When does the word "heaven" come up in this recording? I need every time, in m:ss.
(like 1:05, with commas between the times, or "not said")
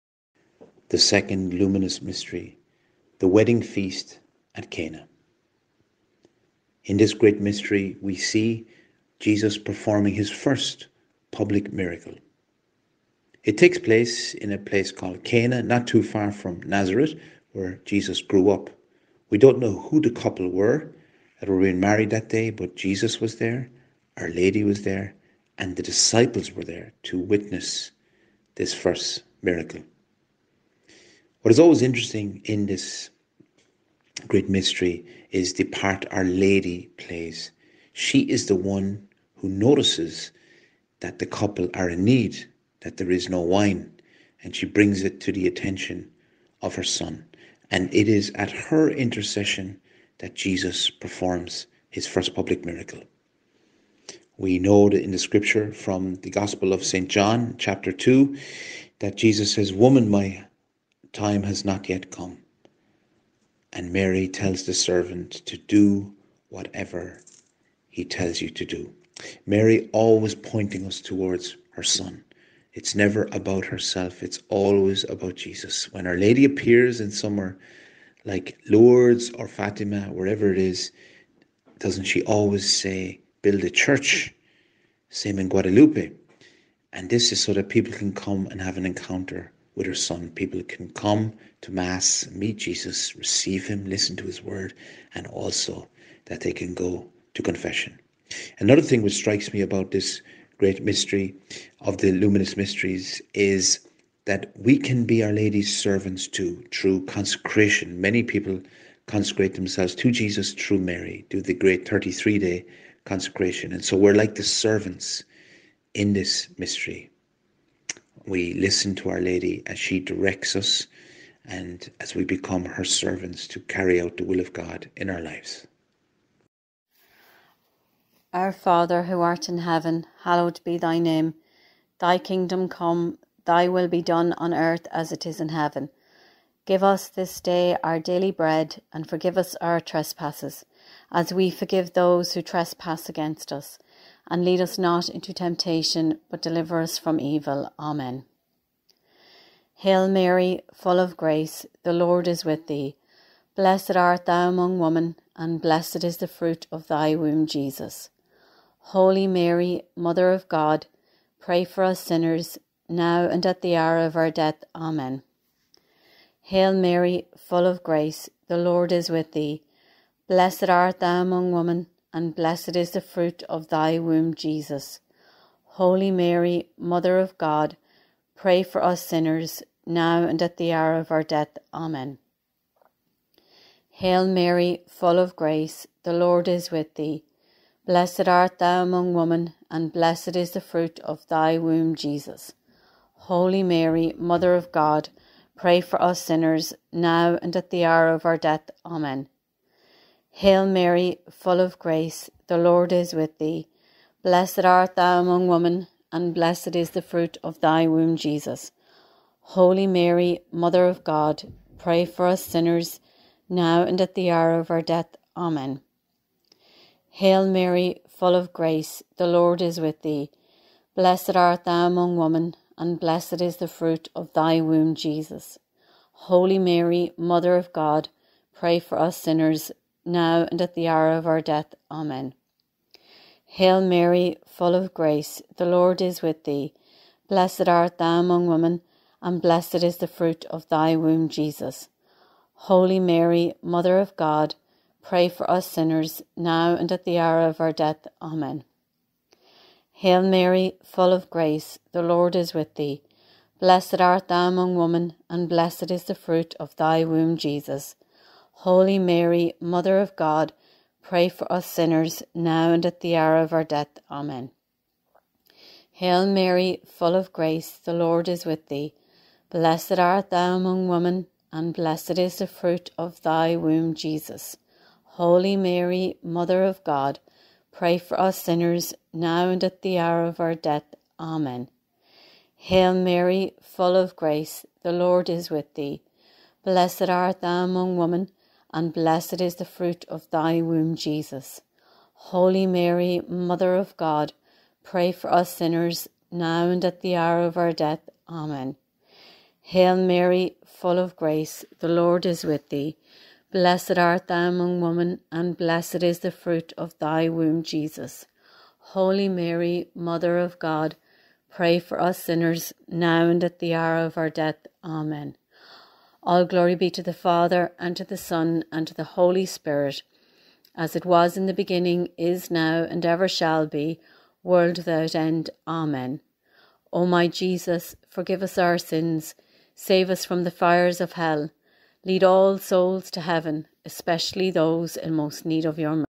2:09, 2:15, 5:33.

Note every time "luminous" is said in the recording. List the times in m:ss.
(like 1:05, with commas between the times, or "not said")
0:01, 1:42.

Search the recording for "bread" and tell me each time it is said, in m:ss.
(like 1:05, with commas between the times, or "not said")
2:18.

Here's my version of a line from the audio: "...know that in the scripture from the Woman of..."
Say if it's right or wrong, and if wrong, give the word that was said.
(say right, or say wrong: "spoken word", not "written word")
wrong: "Gospel", not "Woman".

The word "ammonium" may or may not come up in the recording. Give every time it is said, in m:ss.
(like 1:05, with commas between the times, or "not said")
not said.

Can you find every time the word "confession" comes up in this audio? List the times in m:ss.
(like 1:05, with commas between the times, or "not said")
1:37.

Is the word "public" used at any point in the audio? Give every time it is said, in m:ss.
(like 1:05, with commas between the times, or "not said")
0:11, 0:52.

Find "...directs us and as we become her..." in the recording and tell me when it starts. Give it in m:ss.
1:59.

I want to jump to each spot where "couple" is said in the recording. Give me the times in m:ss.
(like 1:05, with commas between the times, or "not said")
0:20, 0:41.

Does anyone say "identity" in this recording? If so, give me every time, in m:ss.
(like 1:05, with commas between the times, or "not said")
not said.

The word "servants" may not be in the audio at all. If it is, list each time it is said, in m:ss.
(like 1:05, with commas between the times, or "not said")
1:04, 1:45, 1:54, 2:02.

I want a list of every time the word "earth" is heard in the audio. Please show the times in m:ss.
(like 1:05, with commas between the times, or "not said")
2:14.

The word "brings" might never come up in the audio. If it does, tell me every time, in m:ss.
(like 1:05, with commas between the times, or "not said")
0:44.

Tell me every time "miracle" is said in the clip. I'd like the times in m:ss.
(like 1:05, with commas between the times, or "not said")
0:11, 0:29, 0:52.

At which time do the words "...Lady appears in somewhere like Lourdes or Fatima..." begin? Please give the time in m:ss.
1:16.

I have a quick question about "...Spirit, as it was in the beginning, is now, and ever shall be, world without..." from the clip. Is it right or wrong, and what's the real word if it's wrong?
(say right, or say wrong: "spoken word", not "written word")
right.